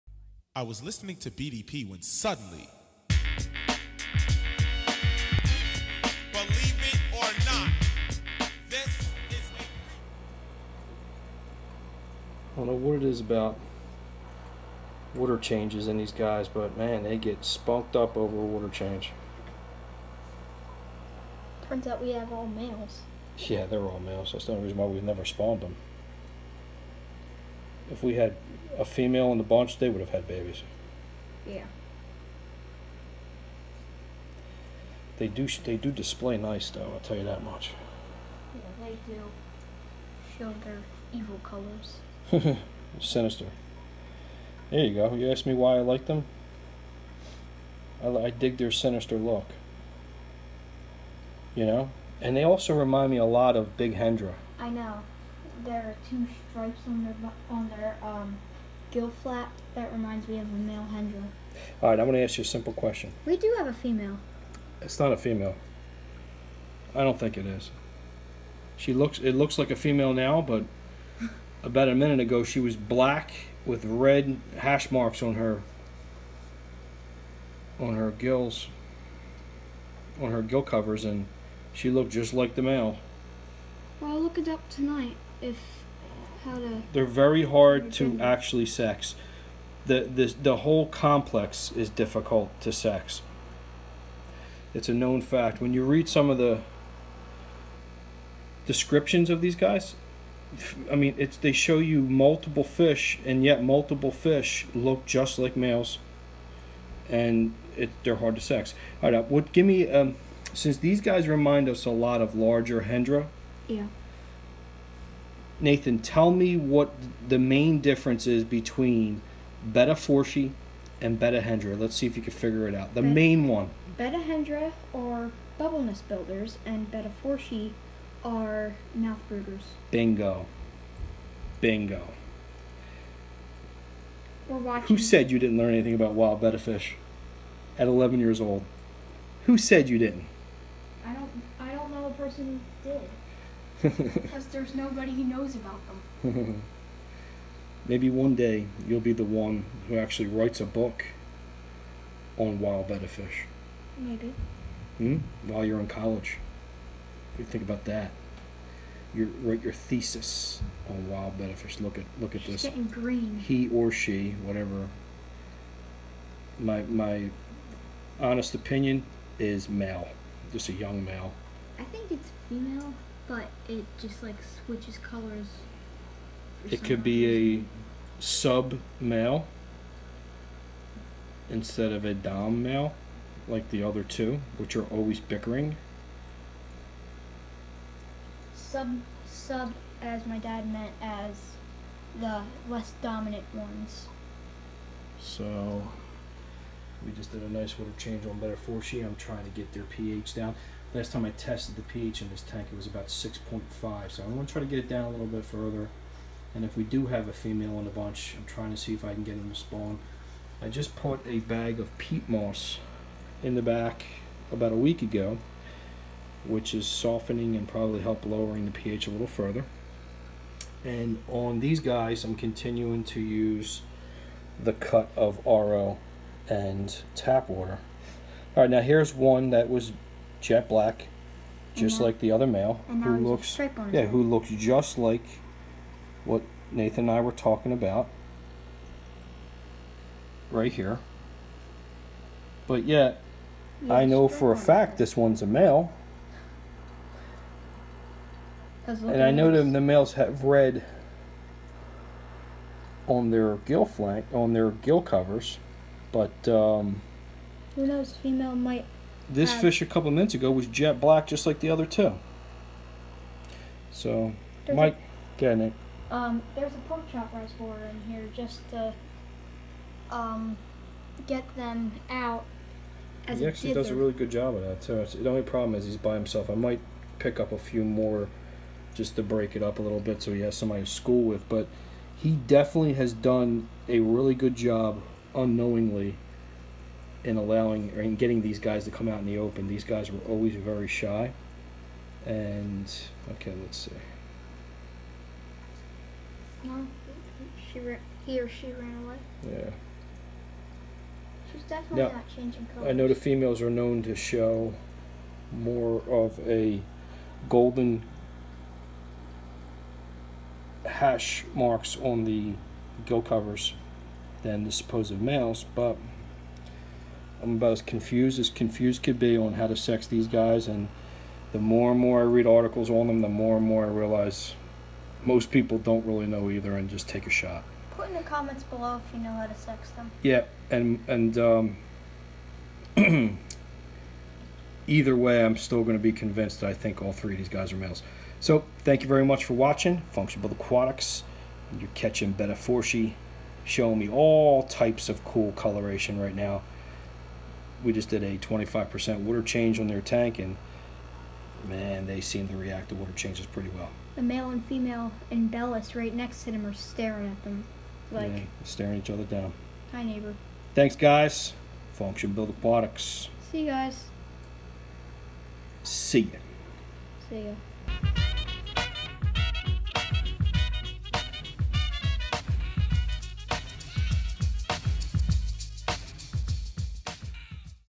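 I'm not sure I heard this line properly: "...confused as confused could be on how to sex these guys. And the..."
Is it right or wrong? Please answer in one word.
right.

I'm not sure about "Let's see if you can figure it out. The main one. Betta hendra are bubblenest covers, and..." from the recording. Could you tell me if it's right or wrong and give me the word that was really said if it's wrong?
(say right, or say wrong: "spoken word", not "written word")
wrong: "builders", not "covers".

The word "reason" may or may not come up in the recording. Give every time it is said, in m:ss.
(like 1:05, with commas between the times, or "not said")
0:24, 2:57.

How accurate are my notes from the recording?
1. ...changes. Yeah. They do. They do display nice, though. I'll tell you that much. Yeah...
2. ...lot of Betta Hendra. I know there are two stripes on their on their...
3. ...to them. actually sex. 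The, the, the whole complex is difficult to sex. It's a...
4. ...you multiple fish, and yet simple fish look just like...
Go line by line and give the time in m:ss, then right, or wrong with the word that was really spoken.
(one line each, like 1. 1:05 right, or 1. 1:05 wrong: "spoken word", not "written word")
1. 0:30 wrong: "babies", not "changes"
2. 0:53 wrong: "Big", not "Betta"
3. 1:27 right
4. 1:41 wrong: "multiple", not "simple".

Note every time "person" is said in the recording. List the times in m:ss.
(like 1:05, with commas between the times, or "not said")
2:22.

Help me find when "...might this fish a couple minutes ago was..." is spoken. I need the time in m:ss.
4:18.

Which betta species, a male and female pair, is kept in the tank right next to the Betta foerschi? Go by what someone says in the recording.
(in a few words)
Imbellis.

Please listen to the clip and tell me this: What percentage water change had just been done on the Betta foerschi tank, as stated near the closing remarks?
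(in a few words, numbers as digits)
25%.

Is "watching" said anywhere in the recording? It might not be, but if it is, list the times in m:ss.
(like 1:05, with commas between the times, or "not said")
2:14, 5:39.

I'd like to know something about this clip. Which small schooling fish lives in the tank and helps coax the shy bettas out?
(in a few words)
Pork chop rasbora.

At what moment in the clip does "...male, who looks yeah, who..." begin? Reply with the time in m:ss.
3:52.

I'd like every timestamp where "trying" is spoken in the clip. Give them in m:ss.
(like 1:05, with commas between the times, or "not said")
3:19, 3:28.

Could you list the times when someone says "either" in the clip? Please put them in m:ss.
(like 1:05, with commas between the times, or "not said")
5:26, 5:34.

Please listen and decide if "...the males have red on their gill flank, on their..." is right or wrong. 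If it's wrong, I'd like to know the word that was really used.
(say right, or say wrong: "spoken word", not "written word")
right.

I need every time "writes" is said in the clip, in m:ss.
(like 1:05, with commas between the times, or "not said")
2:30, 2:39.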